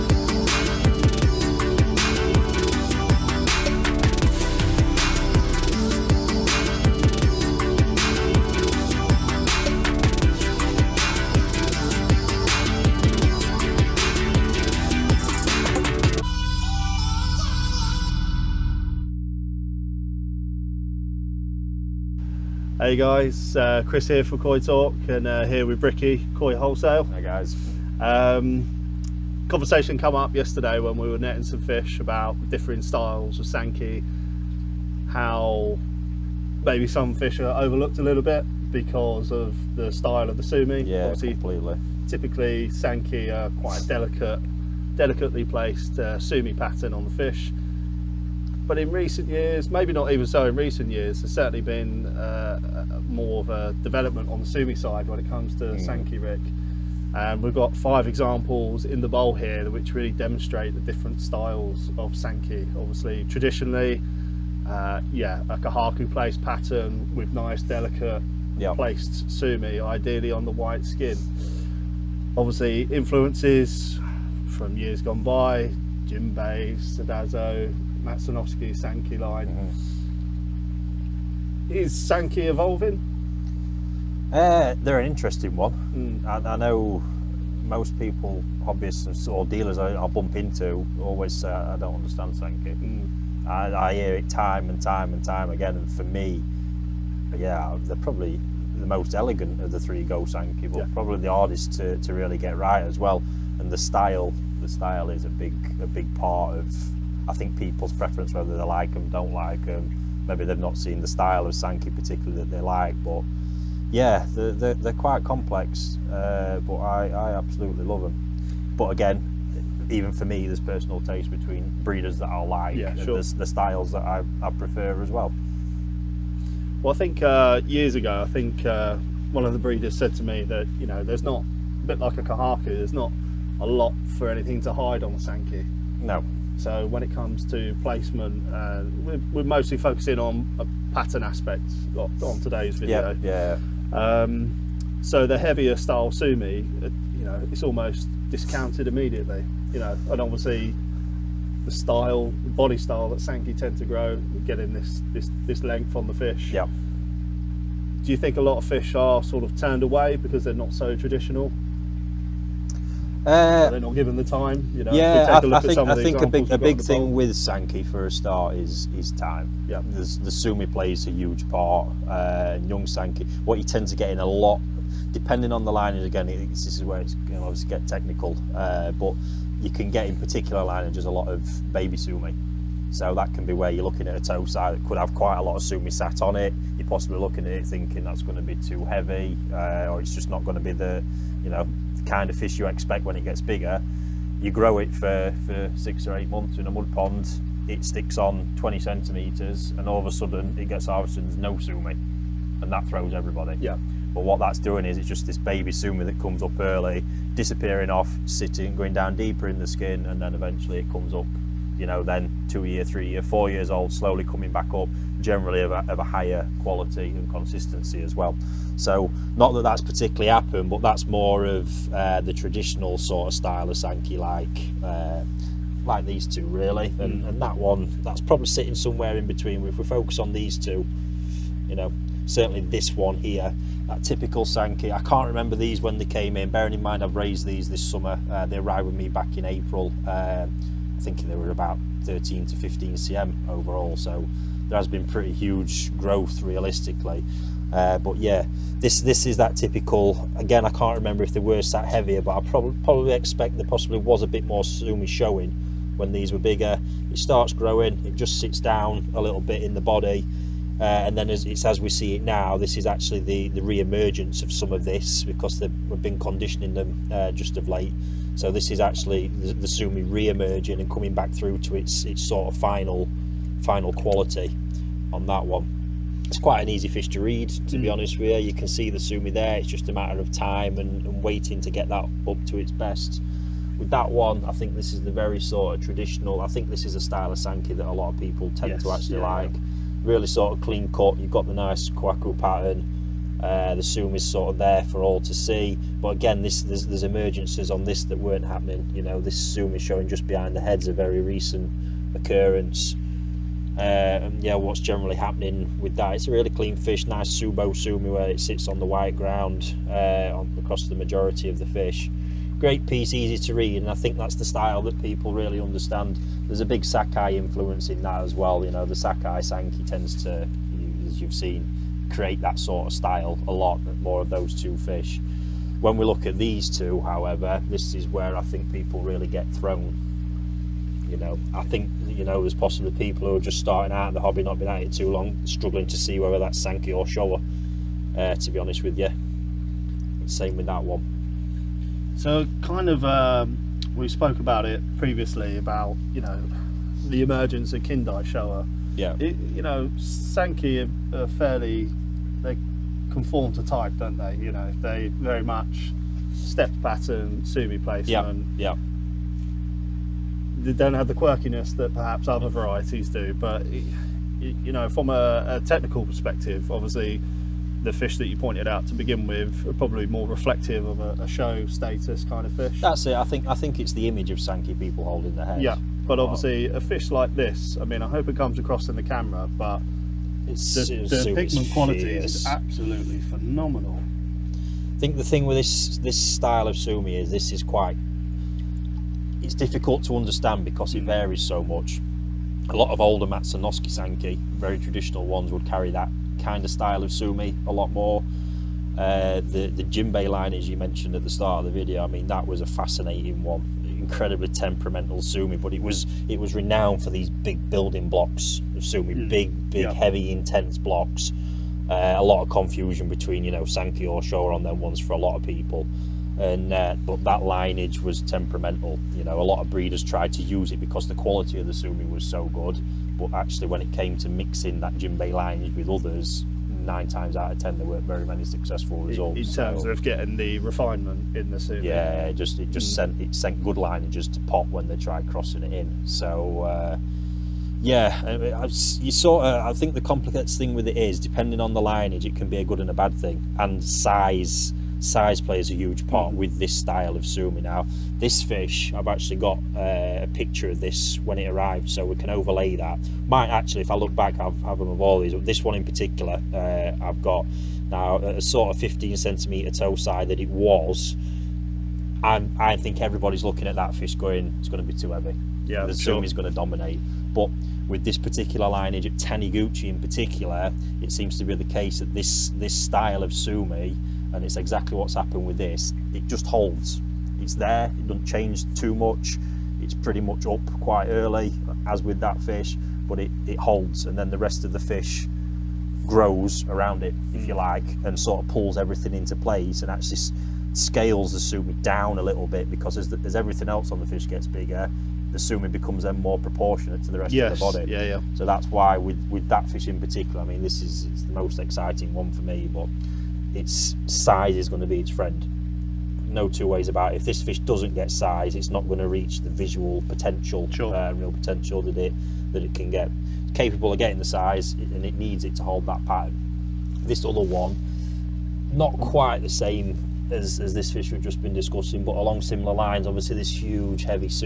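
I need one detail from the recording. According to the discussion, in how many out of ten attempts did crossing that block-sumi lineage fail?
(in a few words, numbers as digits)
9.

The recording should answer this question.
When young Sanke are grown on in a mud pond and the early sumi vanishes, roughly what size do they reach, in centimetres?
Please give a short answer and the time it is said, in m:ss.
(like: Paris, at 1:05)
20 centimetres, at 3:18.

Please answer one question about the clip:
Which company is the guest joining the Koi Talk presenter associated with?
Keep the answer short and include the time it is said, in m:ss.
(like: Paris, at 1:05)
Koi Wholesale, at 0:26.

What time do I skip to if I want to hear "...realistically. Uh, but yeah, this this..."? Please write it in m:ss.
4:06.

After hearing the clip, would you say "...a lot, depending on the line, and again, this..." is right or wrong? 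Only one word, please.
right.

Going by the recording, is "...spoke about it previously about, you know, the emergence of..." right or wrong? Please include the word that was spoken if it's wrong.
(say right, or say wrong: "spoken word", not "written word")
right.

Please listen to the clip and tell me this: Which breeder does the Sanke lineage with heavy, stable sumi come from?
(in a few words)
Taniguchi.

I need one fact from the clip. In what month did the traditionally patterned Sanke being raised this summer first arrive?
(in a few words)
April.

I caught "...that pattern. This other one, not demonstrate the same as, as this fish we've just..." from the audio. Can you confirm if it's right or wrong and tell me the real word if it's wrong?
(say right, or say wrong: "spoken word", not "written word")
wrong: "quite", not "demonstrate".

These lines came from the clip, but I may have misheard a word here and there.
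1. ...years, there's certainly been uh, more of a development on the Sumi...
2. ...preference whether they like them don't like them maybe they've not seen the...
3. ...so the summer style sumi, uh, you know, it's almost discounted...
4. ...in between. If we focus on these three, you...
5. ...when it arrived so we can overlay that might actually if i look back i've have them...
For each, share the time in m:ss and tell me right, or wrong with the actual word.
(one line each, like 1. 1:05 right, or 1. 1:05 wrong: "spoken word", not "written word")
1. 0:50 right
2. 1:47 right
3. 2:25 wrong: "heavier", not "summer"
4. 3:49 wrong: "two", not "three"
5. 7:31 right.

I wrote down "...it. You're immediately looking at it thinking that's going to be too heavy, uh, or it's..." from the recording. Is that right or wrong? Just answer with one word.
wrong.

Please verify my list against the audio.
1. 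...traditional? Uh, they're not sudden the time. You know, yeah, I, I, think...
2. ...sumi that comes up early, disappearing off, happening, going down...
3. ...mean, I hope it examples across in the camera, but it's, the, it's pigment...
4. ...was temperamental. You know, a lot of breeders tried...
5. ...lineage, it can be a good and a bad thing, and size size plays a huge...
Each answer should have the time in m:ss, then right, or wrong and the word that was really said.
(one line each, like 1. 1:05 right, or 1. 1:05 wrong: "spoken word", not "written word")
1. 2:40 wrong: "given", not "sudden"
2. 3:25 wrong: "sitting", not "happening"
3. 6:17 wrong: "comes", not "examples"
4. 6:58 right
5. 7:21 right.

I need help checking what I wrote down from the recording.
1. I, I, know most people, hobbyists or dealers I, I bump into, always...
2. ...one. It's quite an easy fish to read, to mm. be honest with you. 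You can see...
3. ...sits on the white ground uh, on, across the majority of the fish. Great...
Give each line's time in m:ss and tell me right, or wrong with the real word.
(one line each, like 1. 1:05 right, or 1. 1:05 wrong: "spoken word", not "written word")
1. 1:26 right
2. 4:35 right
3. 5:08 right.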